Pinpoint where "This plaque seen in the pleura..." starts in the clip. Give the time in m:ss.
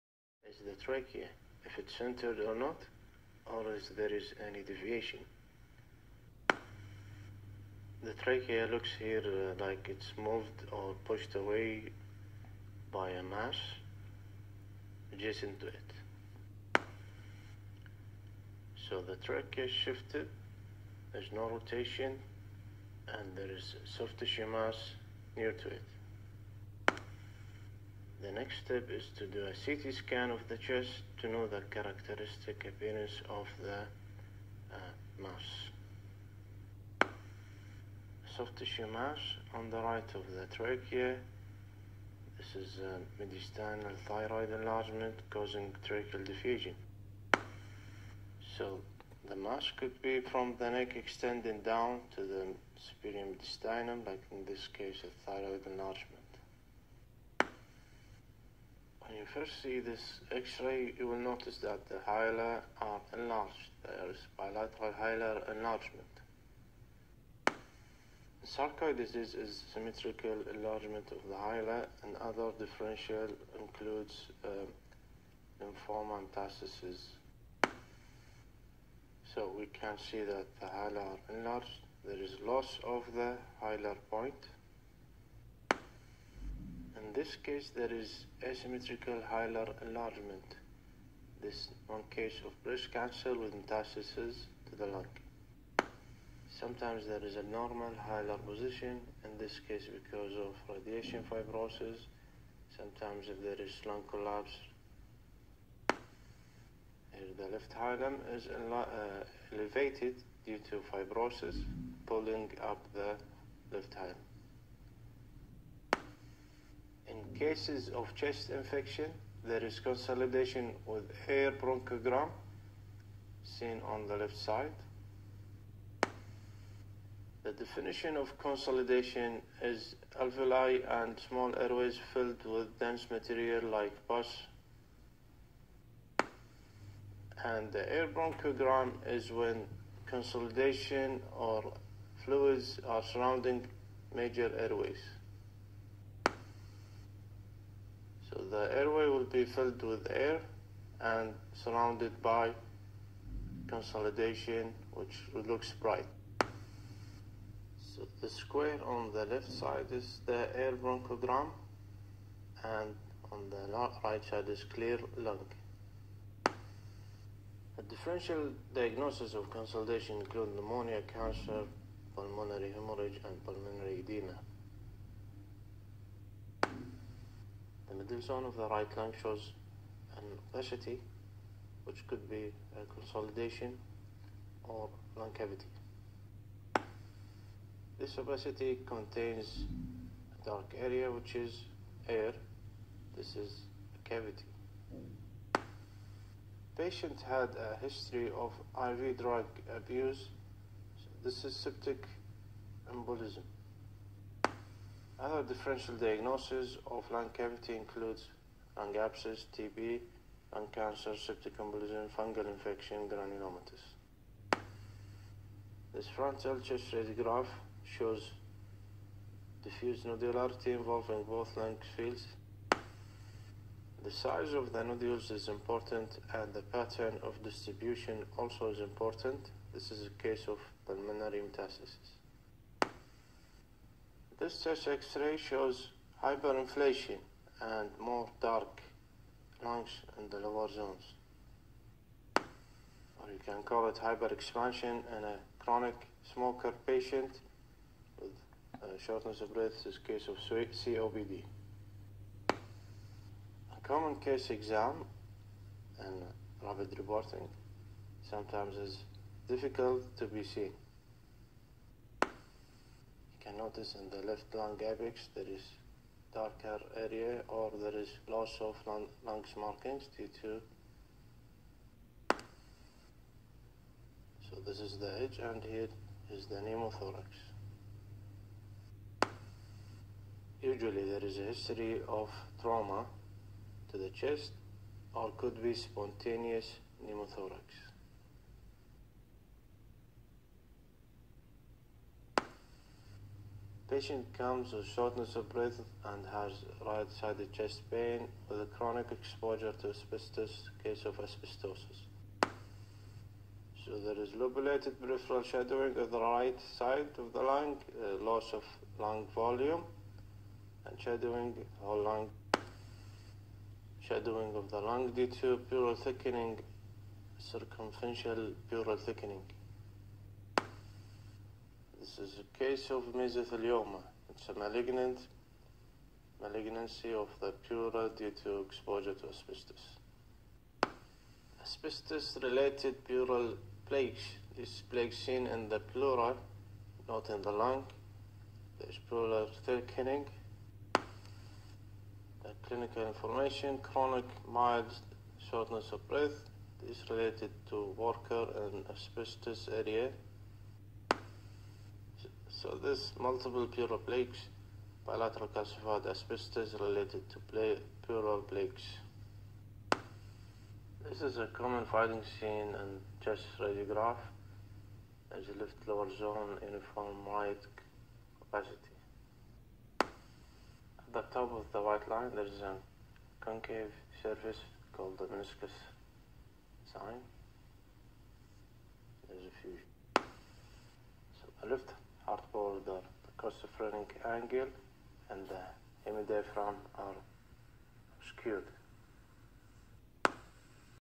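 5:34.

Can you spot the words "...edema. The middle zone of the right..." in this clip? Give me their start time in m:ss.
2:53.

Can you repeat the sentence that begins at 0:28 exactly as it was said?
The next step is to do a CT scan of the chest to know the characteristic appearance of the uh, mass.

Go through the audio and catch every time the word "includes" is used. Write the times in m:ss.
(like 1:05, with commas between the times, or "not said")
1:13, 2:50, 3:27.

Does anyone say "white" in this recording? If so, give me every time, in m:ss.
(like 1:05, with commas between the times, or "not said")
6:07, 6:11.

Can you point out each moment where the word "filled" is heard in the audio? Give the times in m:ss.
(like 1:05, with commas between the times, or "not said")
2:12, 2:29.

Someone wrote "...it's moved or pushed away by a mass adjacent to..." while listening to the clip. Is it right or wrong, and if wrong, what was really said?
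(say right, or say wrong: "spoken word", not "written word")
right.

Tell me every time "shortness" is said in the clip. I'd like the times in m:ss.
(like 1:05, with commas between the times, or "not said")
4:09, 4:54, 5:45.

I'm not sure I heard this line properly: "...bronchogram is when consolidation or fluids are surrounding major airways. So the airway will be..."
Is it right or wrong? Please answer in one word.
right.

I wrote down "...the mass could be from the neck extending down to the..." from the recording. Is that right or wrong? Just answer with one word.
right.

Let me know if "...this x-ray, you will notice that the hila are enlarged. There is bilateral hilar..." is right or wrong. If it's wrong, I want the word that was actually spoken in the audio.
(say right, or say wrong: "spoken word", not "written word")
right.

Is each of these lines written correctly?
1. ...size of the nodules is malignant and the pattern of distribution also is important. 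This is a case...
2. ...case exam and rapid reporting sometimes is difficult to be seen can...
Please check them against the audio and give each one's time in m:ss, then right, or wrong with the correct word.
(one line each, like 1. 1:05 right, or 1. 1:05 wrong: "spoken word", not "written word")
1. 3:44 wrong: "important", not "malignant"
2. 4:14 right.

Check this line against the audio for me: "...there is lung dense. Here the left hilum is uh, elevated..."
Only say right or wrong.
wrong.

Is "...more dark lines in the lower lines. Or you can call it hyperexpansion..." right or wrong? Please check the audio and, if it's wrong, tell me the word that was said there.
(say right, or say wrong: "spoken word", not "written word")
wrong: "zones", not "lines".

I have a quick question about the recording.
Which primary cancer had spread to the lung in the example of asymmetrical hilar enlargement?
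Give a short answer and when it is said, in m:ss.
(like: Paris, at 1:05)
Breast cancer, at 1:32.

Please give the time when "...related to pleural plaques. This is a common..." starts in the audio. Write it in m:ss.
5:56.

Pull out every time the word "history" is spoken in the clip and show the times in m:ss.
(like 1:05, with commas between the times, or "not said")
3:17, 4:41.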